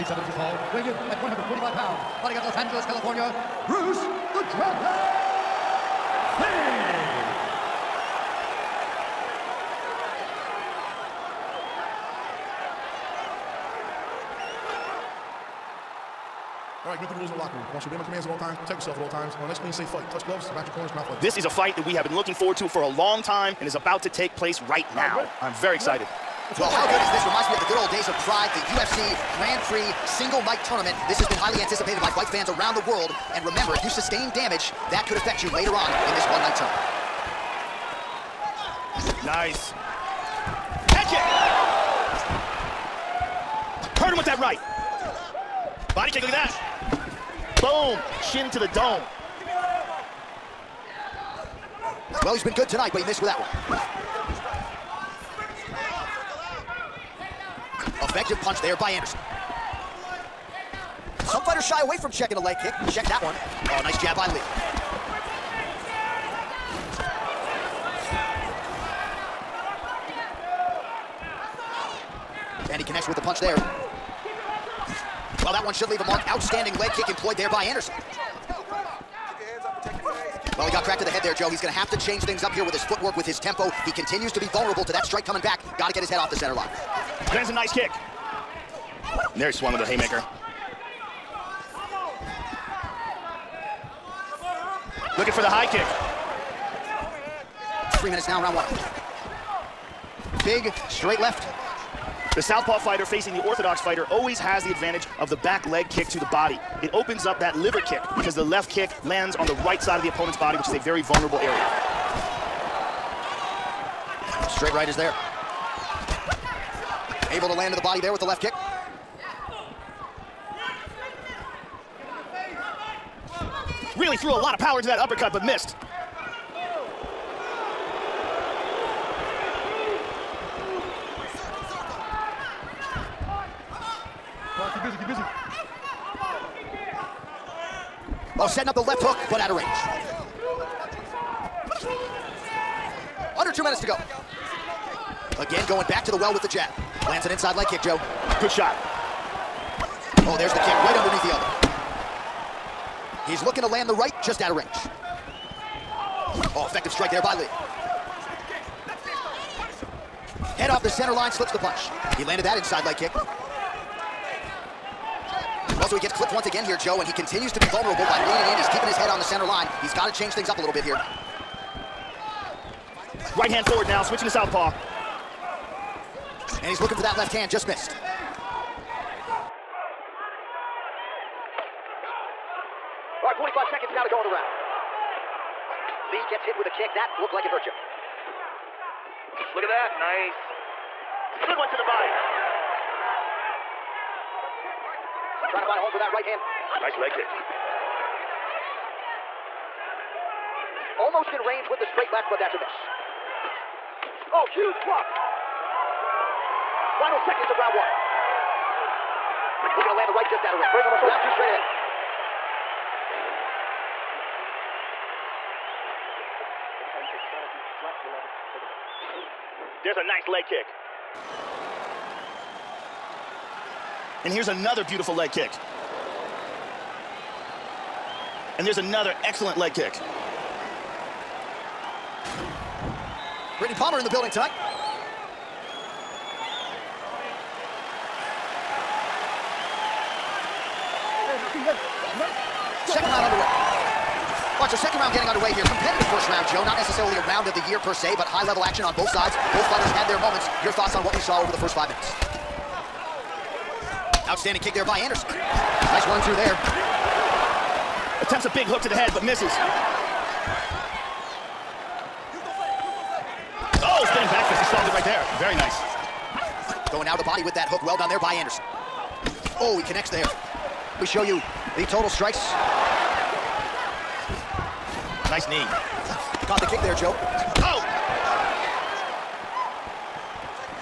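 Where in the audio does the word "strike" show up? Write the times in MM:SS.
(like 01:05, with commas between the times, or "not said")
01:25, 02:36, 04:32.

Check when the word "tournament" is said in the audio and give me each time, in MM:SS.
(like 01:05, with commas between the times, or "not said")
00:30, 00:39.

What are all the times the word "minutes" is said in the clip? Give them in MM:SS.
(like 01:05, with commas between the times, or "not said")
01:38, 02:23, 04:11.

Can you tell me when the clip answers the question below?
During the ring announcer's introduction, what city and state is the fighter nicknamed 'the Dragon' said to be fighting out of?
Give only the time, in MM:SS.
00:02.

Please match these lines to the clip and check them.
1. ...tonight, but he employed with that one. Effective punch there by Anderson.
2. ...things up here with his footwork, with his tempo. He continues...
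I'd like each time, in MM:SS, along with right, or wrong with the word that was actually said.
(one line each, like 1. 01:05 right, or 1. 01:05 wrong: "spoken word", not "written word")
1. 00:52 wrong: "missed", not "employed"
2. 01:22 right.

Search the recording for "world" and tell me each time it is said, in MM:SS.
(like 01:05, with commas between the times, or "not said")
00:32.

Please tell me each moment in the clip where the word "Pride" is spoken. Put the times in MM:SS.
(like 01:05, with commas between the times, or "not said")
00:28.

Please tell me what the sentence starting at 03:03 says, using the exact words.
All right, 45 seconds now to go in the round.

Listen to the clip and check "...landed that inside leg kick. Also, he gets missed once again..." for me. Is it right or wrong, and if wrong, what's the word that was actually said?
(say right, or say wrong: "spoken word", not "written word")
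wrong: "clipped", not "missed".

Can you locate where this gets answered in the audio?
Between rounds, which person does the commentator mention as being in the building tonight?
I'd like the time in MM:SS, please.
03:53.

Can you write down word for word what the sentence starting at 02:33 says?
He's looking to land the right just out of range.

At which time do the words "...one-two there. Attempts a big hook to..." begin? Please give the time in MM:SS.
04:16.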